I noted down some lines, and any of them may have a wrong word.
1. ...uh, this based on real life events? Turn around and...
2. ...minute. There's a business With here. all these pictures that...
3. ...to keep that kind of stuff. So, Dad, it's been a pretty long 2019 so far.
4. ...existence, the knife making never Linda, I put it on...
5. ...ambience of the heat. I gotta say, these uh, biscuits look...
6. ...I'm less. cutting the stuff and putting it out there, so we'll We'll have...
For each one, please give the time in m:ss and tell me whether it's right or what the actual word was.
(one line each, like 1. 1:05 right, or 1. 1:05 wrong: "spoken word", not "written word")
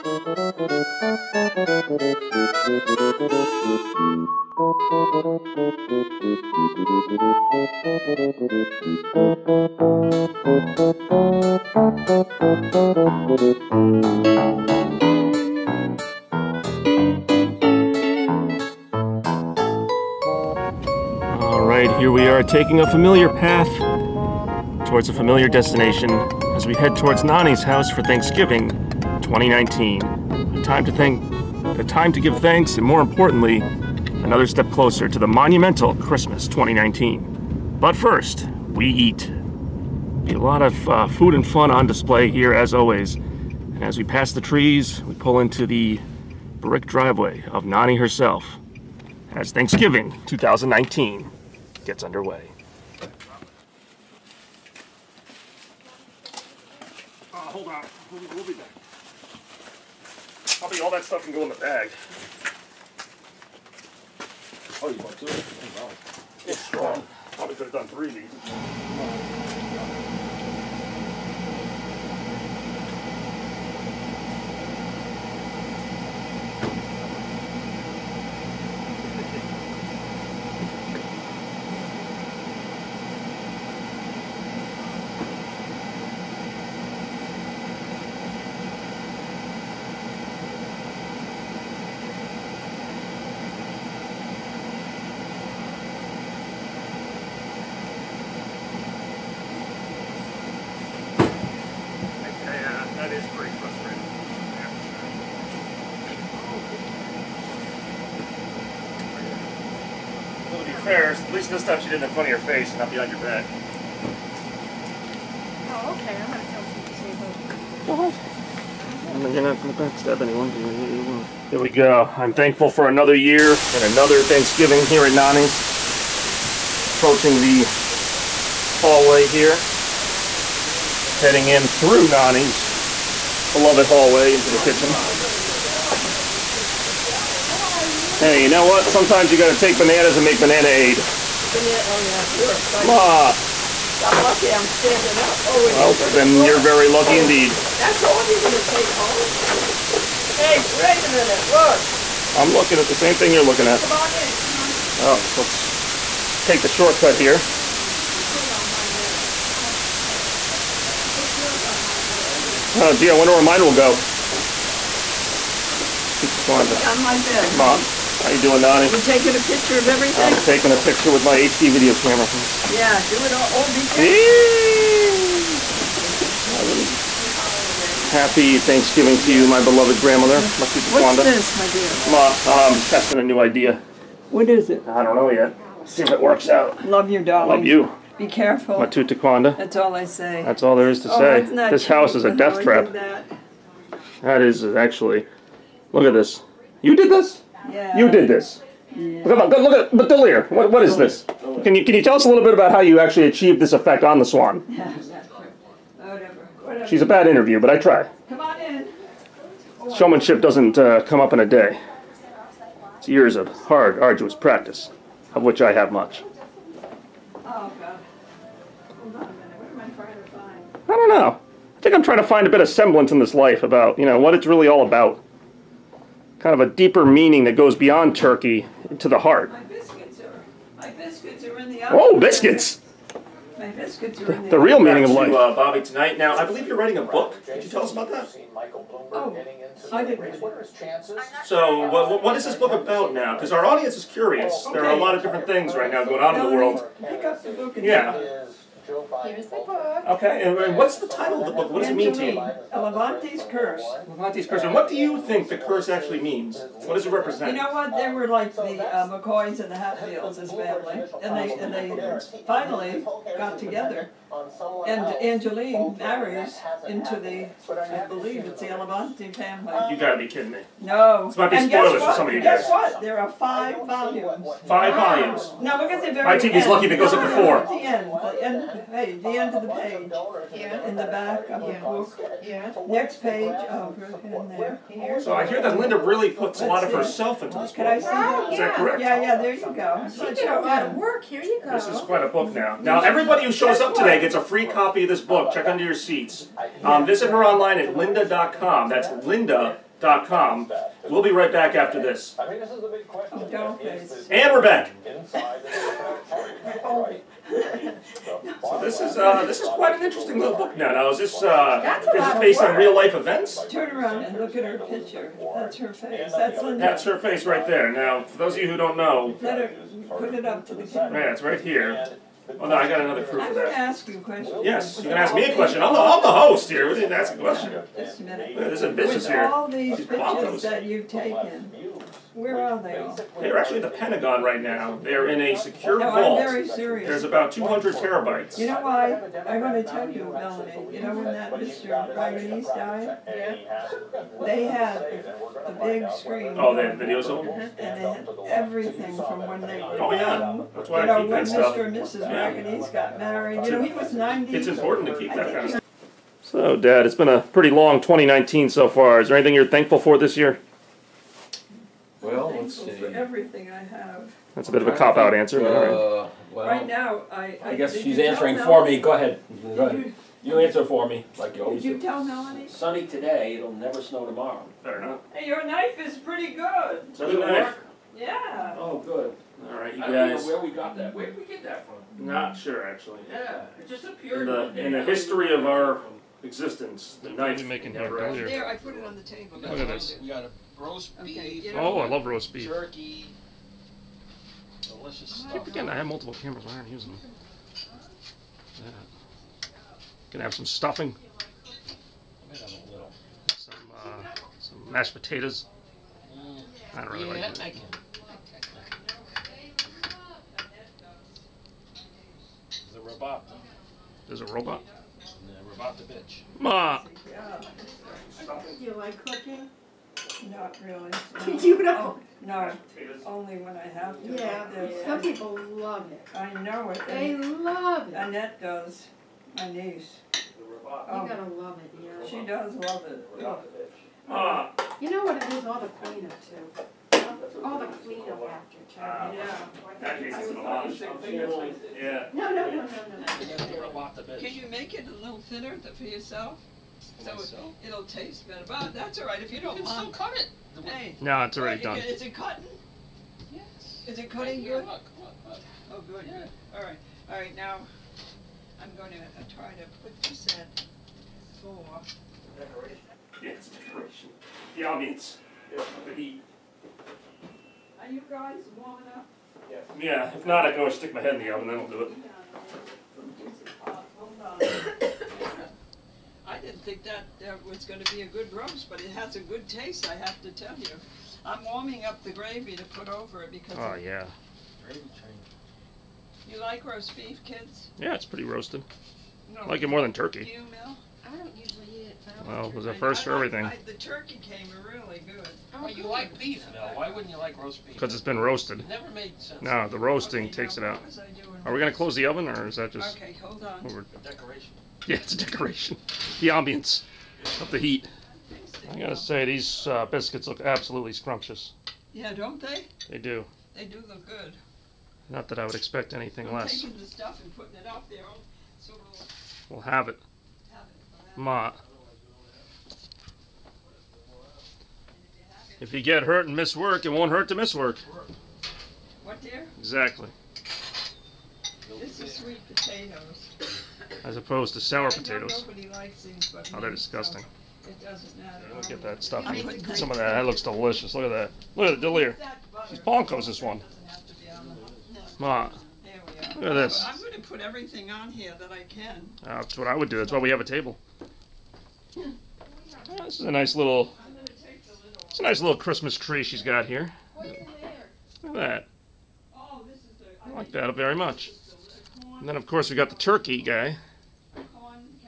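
1. 5:11 right
2. 5:28 right
3. 5:55 right
4. 6:26 wrong: "There", not "Linda"
5. 8:26 right
6. 8:36 wrong: "taking", not "cutting".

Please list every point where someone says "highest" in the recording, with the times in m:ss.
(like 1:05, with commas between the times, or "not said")
not said.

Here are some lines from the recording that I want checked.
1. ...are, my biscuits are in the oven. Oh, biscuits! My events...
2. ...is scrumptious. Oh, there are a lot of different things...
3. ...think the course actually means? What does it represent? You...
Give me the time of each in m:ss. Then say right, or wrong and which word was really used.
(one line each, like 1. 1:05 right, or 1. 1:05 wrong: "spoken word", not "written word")
1. 3:50 wrong: "biscuits", not "events"
2. 4:03 wrong: "curious", not "scrumptious"
3. 4:15 wrong: "curse", not "course".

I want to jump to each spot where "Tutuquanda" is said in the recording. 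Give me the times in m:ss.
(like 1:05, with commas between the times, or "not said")
2:46.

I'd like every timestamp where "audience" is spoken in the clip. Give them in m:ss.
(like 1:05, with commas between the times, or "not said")
4:03, 7:44.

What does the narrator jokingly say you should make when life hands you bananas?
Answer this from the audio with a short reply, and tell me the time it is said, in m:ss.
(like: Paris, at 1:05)
banana aid, at 2:20.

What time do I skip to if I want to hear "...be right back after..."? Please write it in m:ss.
5:01.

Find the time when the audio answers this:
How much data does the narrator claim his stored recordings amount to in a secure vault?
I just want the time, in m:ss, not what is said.
5:37.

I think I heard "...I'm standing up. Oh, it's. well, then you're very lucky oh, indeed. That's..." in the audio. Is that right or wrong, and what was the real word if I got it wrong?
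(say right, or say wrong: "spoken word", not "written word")
right.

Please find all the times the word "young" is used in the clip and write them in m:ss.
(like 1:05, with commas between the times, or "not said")
5:50.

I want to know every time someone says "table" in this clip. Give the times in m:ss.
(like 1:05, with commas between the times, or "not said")
6:29, 9:10.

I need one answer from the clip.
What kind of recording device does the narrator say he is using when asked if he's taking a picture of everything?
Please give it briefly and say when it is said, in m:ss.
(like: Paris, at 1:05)
HD video camera, at 2:51.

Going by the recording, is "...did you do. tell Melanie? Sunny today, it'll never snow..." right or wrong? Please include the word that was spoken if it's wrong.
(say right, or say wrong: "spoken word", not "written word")
right.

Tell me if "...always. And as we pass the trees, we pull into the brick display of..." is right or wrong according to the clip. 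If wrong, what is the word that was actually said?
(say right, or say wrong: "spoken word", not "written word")
wrong: "driveway", not "display".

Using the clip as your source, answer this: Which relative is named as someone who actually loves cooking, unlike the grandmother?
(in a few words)
Annette.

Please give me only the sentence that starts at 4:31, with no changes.
This might be and spoilers for some of you guys.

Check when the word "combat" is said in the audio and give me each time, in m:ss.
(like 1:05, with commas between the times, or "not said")
not said.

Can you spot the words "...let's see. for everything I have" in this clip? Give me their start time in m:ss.
6:02.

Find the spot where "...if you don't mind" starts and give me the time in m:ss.
7:29.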